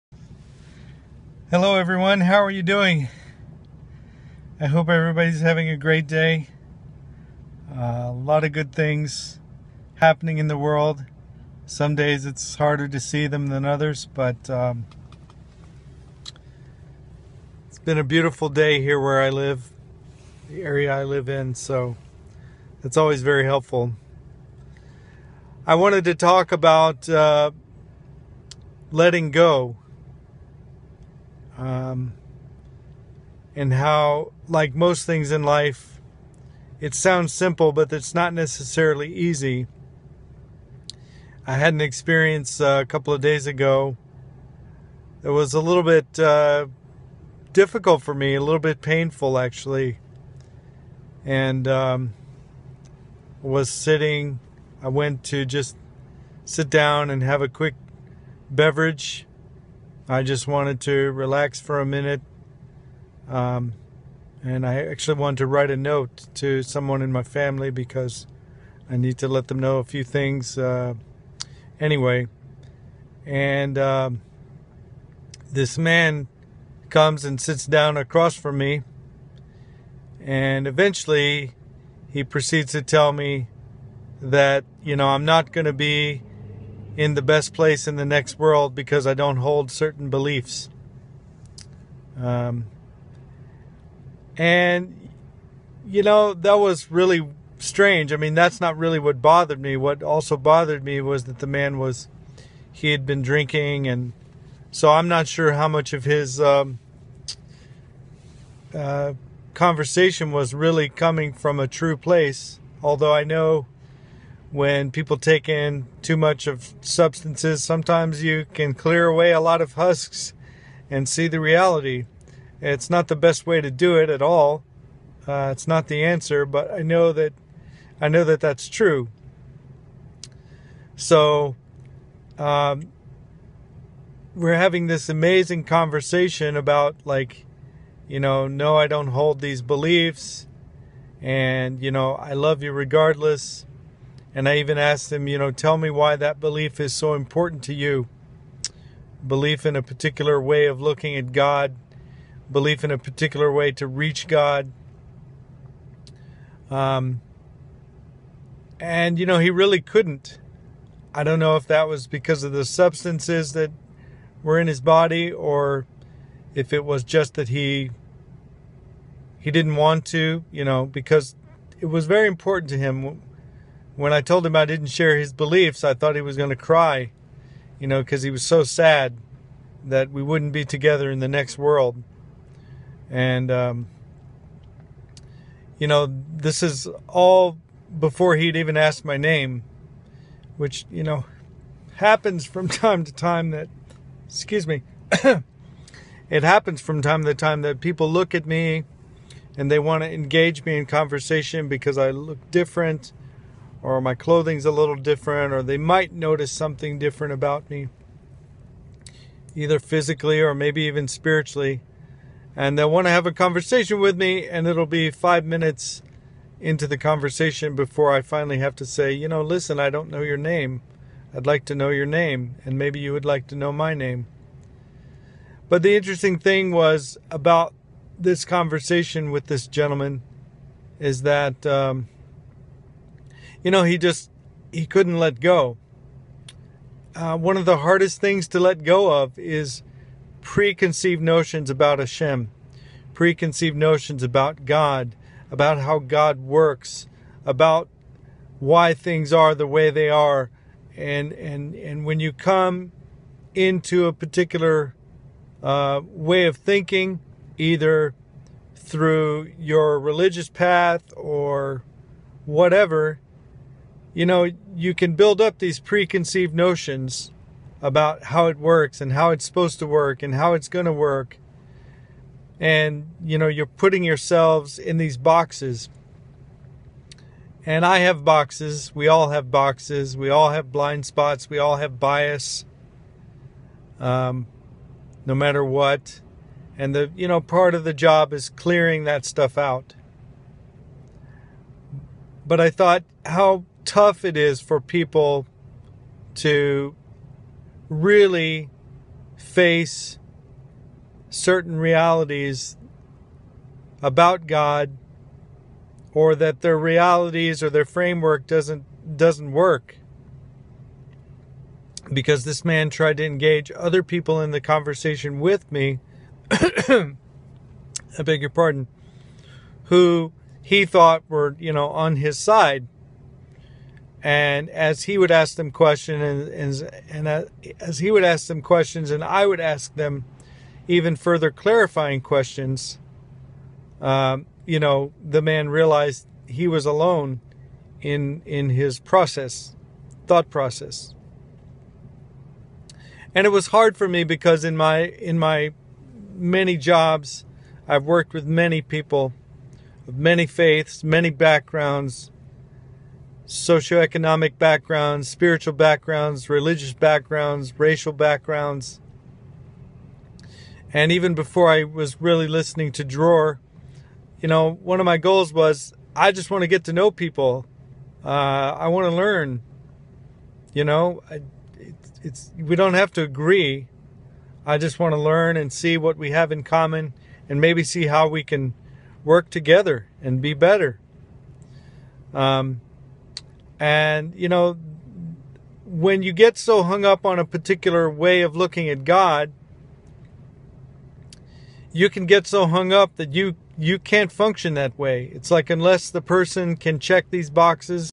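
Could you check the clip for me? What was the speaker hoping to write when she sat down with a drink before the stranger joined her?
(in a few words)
a note.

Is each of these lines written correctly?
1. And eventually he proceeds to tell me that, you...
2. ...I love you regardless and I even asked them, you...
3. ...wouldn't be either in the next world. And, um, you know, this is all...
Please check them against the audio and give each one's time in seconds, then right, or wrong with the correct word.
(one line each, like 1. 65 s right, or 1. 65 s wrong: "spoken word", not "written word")
1. 80 s right
2. 142 s right
3. 180 s wrong: "together", not "either".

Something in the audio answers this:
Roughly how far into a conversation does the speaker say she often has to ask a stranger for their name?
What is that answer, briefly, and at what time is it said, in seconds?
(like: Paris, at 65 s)
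5 minutes, at 215 s.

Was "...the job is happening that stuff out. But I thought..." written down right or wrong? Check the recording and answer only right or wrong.
wrong.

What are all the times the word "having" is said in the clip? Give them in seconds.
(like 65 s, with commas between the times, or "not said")
5 s, 134 s.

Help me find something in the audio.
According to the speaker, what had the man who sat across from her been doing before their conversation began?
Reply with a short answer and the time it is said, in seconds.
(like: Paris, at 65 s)
drinking, at 102 s.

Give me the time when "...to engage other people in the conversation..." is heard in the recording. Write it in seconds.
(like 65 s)
313 s.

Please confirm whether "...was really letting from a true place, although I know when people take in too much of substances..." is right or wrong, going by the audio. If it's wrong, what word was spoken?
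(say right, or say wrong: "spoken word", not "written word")
wrong: "coming", not "letting".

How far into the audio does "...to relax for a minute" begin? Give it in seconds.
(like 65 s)
60 s.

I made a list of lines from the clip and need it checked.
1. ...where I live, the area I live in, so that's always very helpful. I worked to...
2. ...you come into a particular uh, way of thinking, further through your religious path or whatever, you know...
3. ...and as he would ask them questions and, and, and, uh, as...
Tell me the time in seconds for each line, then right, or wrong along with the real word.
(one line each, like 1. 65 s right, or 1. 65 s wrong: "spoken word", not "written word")
1. 18 s wrong: "wanted", not "worked"
2. 252 s wrong: "either", not "further"
3. 324 s right.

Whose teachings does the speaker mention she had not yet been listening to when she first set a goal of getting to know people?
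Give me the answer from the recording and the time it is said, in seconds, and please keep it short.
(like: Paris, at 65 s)
Dror, at 363 s.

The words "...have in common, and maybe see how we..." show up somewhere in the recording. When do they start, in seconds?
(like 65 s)
376 s.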